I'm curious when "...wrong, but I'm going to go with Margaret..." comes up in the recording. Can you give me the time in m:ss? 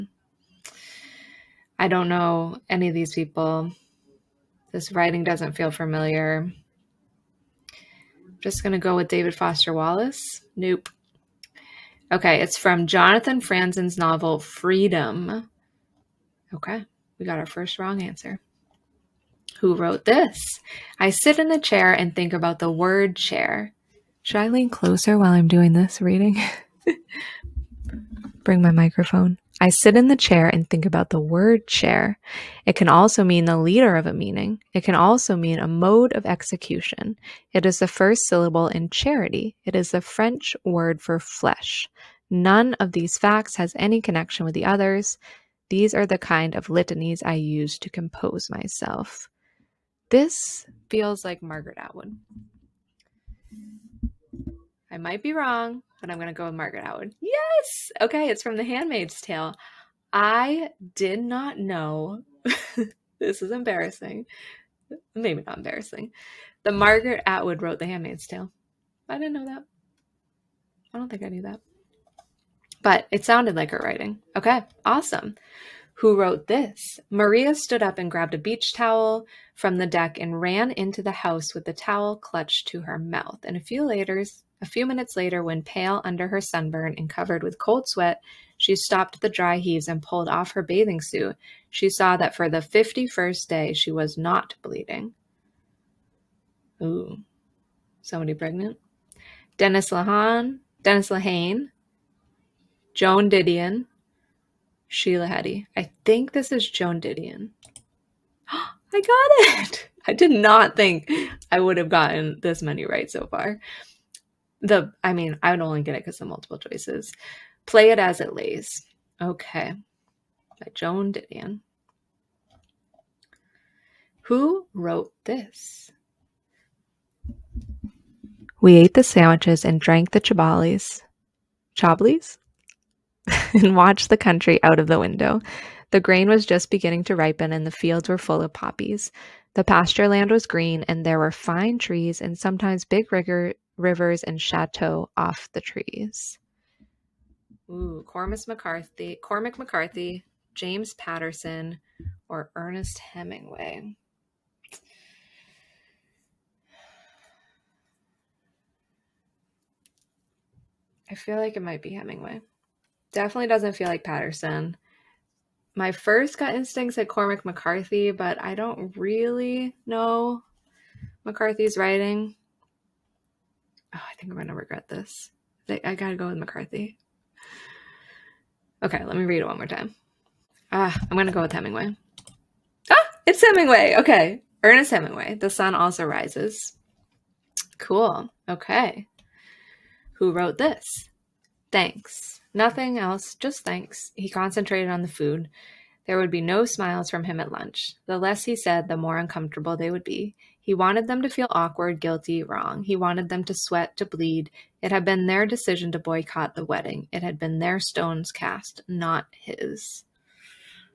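0:55.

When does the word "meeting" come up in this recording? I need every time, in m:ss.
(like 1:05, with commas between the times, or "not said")
0:34.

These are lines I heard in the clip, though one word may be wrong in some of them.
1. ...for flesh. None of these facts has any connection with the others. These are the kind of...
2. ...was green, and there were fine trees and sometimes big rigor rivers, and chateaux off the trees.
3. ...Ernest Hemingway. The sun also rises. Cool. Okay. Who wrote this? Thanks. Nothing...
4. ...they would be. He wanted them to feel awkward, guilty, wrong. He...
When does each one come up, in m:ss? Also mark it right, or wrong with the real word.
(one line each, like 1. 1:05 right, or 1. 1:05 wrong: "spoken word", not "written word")
1. 0:41 right
2. 2:20 right
3. 3:04 right
4. 3:19 right.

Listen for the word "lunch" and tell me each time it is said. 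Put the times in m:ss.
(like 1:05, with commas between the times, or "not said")
3:17.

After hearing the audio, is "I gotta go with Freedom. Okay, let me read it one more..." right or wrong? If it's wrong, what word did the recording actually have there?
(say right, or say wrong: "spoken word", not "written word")
wrong: "McCarthy", not "Freedom".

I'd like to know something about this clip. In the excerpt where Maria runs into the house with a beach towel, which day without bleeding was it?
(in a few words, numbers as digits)
51st.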